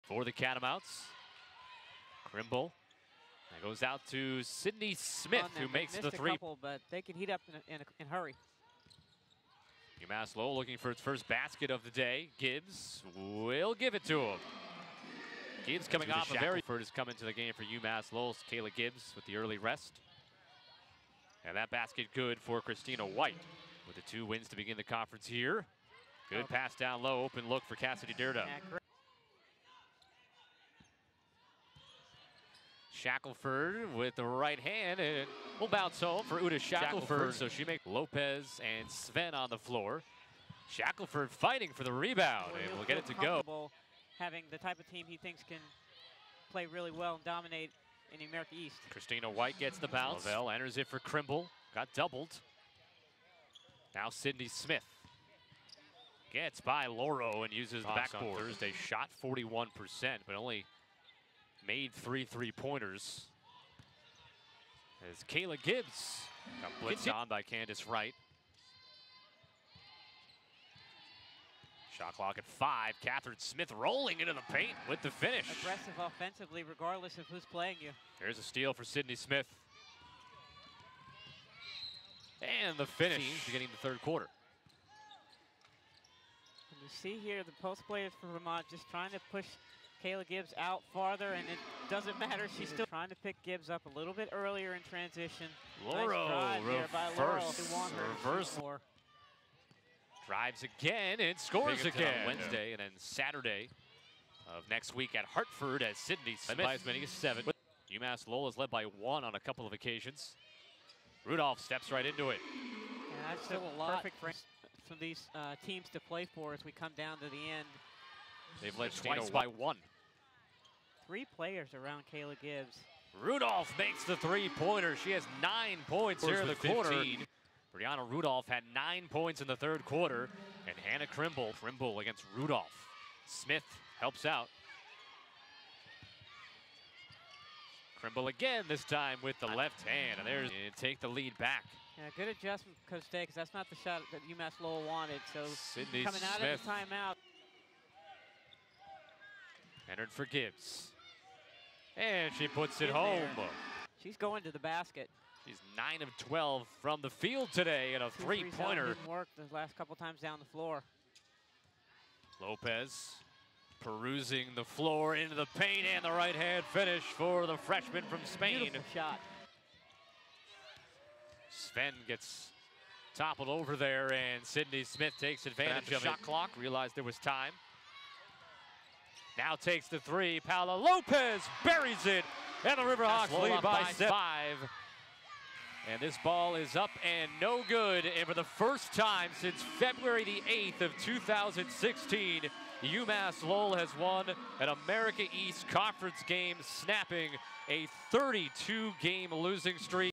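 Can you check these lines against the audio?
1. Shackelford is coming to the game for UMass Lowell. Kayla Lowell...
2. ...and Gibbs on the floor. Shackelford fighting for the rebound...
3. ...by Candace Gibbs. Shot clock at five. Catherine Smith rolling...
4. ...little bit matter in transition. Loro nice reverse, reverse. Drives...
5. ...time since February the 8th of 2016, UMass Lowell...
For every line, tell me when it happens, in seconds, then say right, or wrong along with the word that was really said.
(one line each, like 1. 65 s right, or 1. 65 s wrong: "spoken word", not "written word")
1. 16 s wrong: "Gibbs", not "Lowell"
2. 38 s wrong: "Sven", not "Gibbs"
3. 67 s wrong: "Wright", not "Gibbs"
4. 93 s wrong: "earlier", not "matter"
5. 188 s right.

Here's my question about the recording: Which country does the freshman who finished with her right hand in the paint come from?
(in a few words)
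Spain.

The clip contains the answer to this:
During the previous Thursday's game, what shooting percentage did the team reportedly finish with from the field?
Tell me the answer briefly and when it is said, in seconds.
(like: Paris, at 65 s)
41%, at 59 s.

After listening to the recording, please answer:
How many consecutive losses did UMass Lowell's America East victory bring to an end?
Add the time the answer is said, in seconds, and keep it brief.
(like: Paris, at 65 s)
32, at 198 s.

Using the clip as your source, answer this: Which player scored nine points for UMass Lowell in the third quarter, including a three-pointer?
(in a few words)
Brianna Rudolph.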